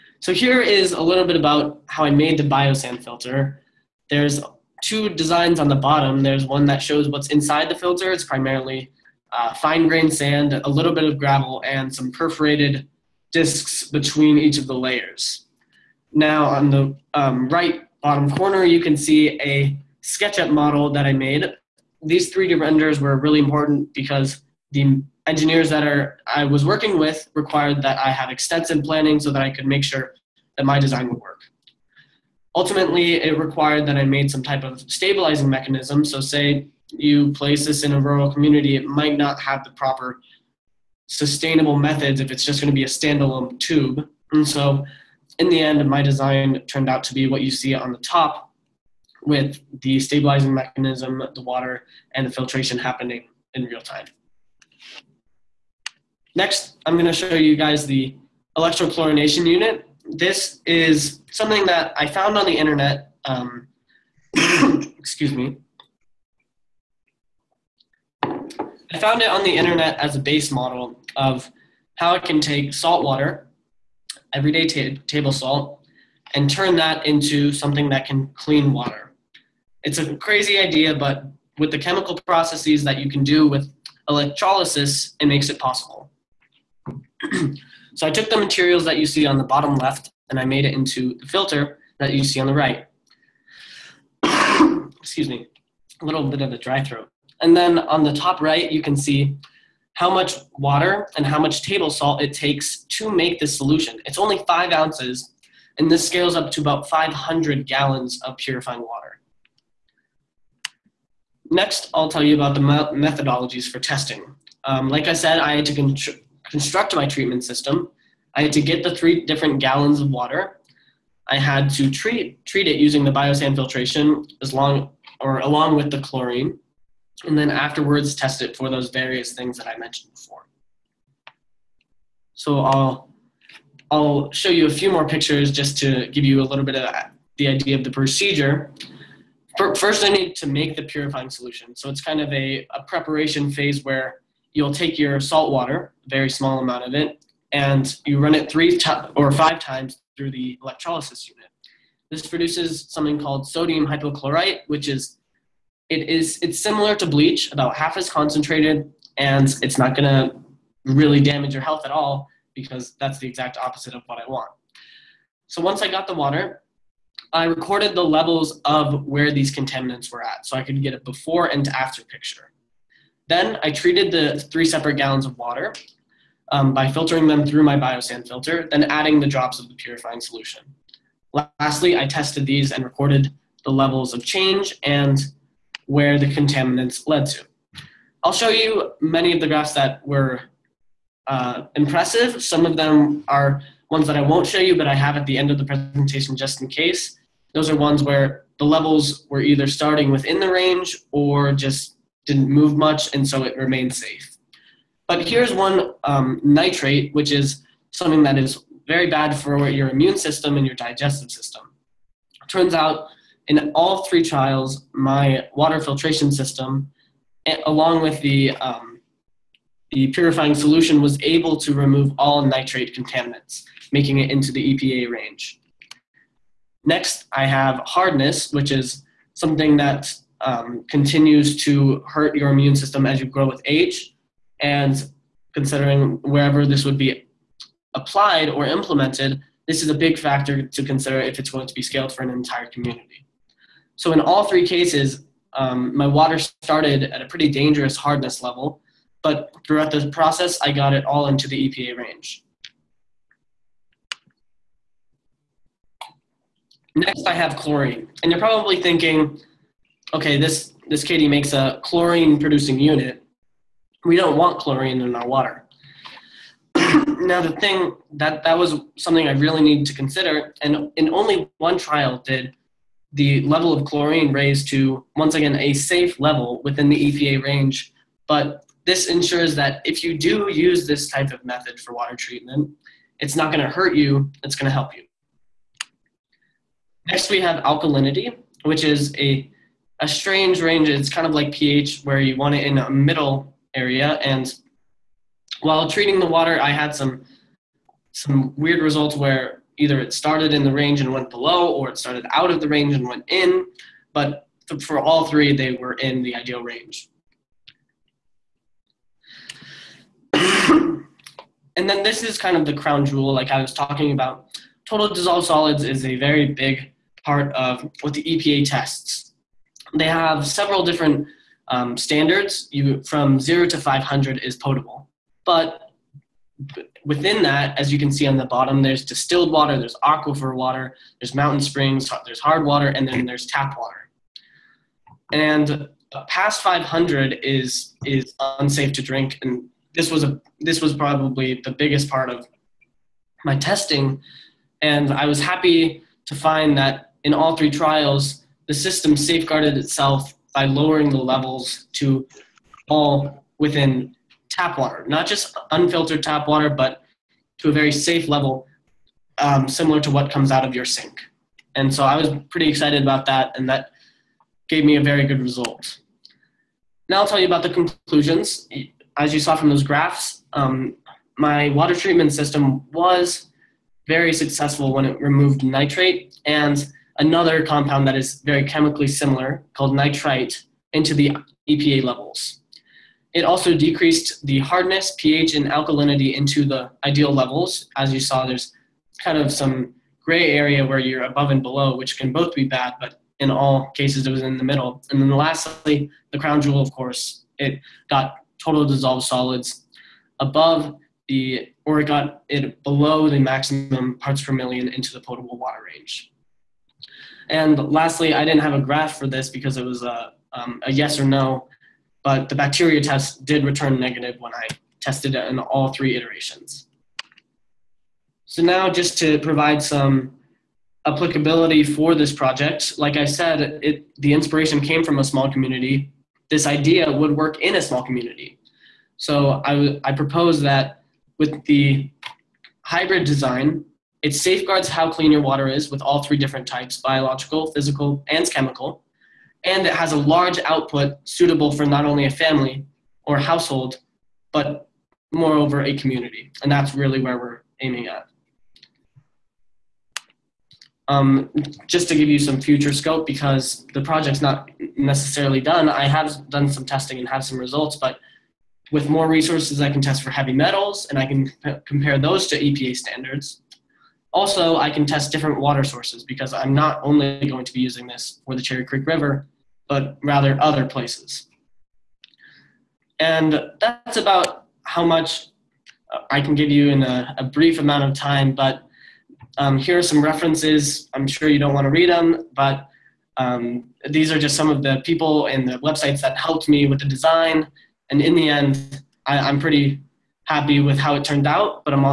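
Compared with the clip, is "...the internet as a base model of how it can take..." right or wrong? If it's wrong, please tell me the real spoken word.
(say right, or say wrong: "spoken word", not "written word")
right.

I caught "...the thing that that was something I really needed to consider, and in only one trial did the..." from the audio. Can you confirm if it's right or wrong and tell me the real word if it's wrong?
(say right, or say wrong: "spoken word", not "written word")
right.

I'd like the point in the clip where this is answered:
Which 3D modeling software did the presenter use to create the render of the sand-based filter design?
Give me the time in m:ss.
0:20.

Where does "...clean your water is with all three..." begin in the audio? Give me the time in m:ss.
7:15.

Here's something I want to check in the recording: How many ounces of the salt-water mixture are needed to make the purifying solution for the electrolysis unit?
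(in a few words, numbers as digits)
5 ounces.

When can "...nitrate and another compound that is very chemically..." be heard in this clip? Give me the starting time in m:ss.
6:15.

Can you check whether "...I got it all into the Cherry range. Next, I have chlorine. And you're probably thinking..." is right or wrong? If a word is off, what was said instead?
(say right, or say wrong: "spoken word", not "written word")
wrong: "EPA", not "Cherry".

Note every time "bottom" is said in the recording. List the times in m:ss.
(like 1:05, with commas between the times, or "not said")
0:05, 0:18, 1:29, 5:28.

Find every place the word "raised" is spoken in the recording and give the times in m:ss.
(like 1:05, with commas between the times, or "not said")
4:34.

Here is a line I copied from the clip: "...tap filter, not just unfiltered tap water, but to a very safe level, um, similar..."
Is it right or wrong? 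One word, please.
wrong.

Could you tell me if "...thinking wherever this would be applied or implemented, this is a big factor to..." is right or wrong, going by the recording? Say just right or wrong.
wrong.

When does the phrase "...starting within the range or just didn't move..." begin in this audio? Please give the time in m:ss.
3:19.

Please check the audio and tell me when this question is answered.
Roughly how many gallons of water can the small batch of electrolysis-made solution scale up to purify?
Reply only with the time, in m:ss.
1:46.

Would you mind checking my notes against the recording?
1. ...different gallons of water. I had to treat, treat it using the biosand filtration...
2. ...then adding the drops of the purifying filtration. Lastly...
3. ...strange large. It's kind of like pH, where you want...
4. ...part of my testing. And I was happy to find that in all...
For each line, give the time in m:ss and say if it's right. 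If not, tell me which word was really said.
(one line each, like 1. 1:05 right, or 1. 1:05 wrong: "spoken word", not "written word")
1. 1:59 right
2. 2:58 wrong: "solution", not "filtration"
3. 4:50 wrong: "range", not "large"
4. 5:42 right.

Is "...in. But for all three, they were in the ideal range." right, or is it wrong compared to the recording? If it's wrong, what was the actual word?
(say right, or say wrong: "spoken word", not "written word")
right.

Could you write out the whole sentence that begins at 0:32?
Ultimately, it required that I made some type of stabilizing mechanism.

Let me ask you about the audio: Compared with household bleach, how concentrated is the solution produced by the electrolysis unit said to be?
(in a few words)
About half.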